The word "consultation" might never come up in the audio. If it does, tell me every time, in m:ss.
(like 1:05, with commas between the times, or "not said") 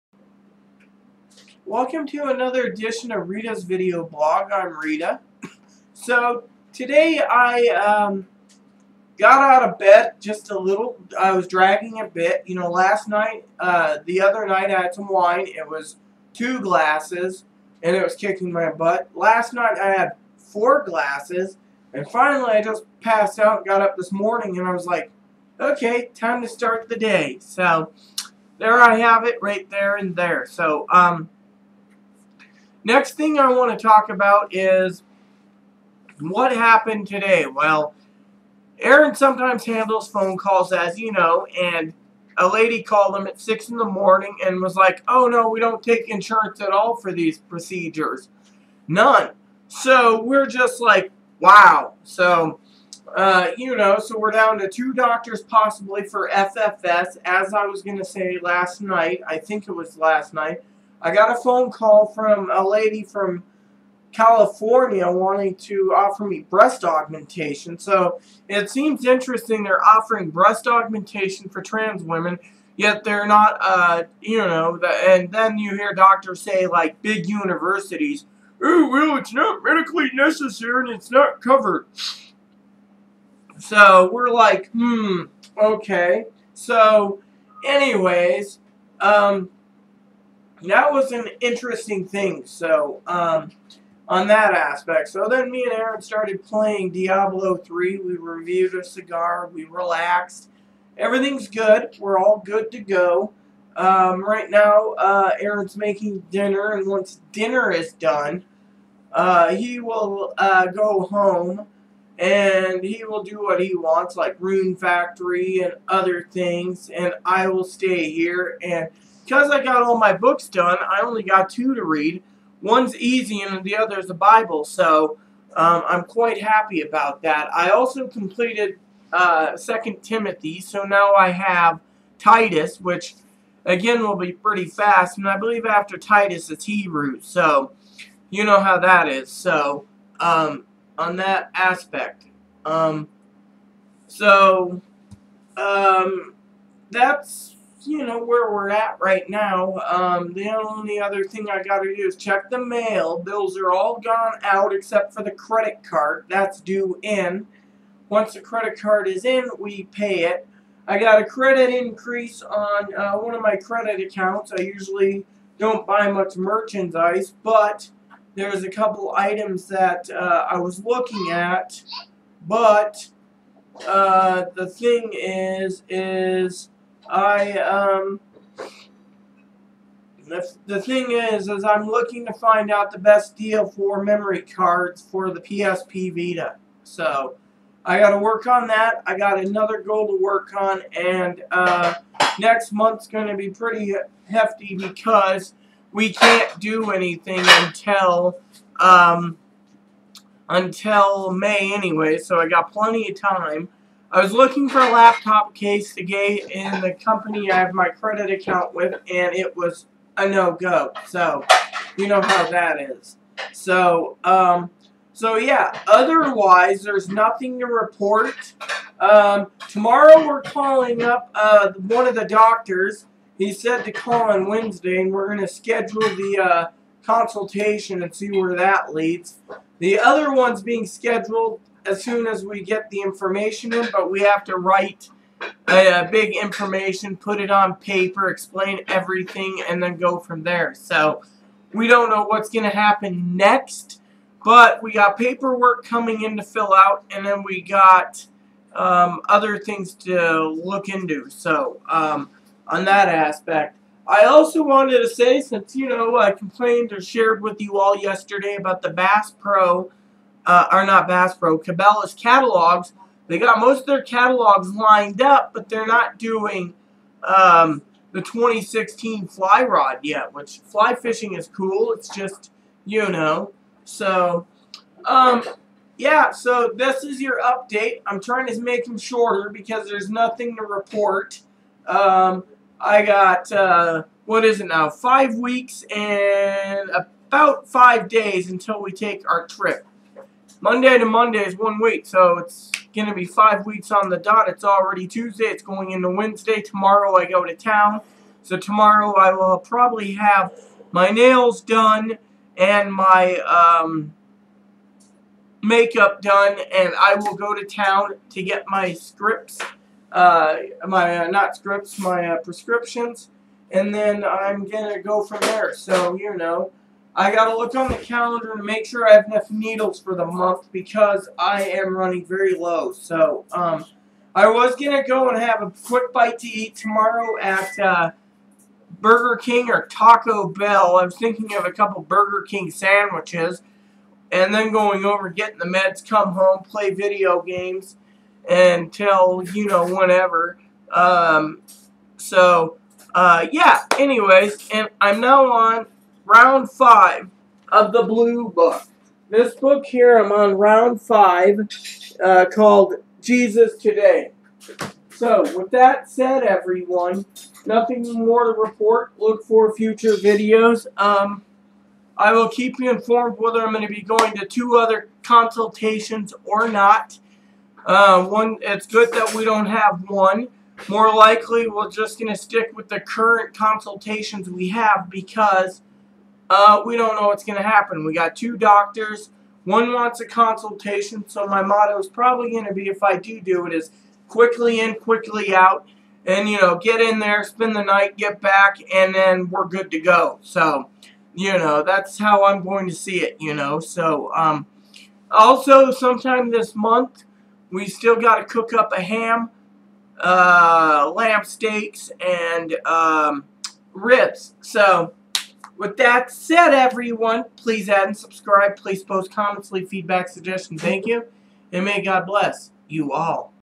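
3:47, 6:05, 6:13, 6:20.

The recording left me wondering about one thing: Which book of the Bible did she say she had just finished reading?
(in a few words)
Timothy.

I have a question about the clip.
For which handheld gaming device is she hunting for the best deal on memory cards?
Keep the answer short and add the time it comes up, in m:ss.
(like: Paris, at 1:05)
PSP Vita, at 3:05.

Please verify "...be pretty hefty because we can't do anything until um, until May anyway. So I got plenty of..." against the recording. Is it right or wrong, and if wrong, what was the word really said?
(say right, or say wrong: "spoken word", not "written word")
right.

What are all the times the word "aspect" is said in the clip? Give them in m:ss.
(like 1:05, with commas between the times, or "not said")
1:34, 2:21, 4:13.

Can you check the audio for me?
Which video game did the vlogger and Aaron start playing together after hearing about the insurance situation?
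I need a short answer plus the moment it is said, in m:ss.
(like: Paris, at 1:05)
Diablo 3, at 1:36.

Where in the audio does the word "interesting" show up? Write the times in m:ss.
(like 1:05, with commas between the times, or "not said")
1:09, 1:31.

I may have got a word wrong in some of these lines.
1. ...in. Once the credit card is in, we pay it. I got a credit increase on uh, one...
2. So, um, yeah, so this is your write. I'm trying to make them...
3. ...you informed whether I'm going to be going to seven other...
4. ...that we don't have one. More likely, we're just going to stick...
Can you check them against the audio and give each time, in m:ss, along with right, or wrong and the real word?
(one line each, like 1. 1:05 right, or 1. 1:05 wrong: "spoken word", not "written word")
1. 2:37 right
2. 4:33 wrong: "update", not "write"
3. 6:02 wrong: "two", not "seven"
4. 6:09 right.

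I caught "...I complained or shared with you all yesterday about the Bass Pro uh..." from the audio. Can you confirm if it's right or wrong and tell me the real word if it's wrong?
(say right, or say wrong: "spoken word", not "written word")
right.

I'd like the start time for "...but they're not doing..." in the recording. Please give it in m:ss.
4:25.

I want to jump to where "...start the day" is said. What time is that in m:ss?
0:26.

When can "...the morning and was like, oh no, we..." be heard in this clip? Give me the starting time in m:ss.
0:43.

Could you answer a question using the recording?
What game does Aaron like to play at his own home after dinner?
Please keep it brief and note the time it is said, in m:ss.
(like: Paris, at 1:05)
Rune Factory, at 1:54.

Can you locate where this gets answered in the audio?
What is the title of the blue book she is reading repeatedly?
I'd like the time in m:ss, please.
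5:53.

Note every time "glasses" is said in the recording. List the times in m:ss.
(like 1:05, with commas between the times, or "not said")
0:16, 0:20.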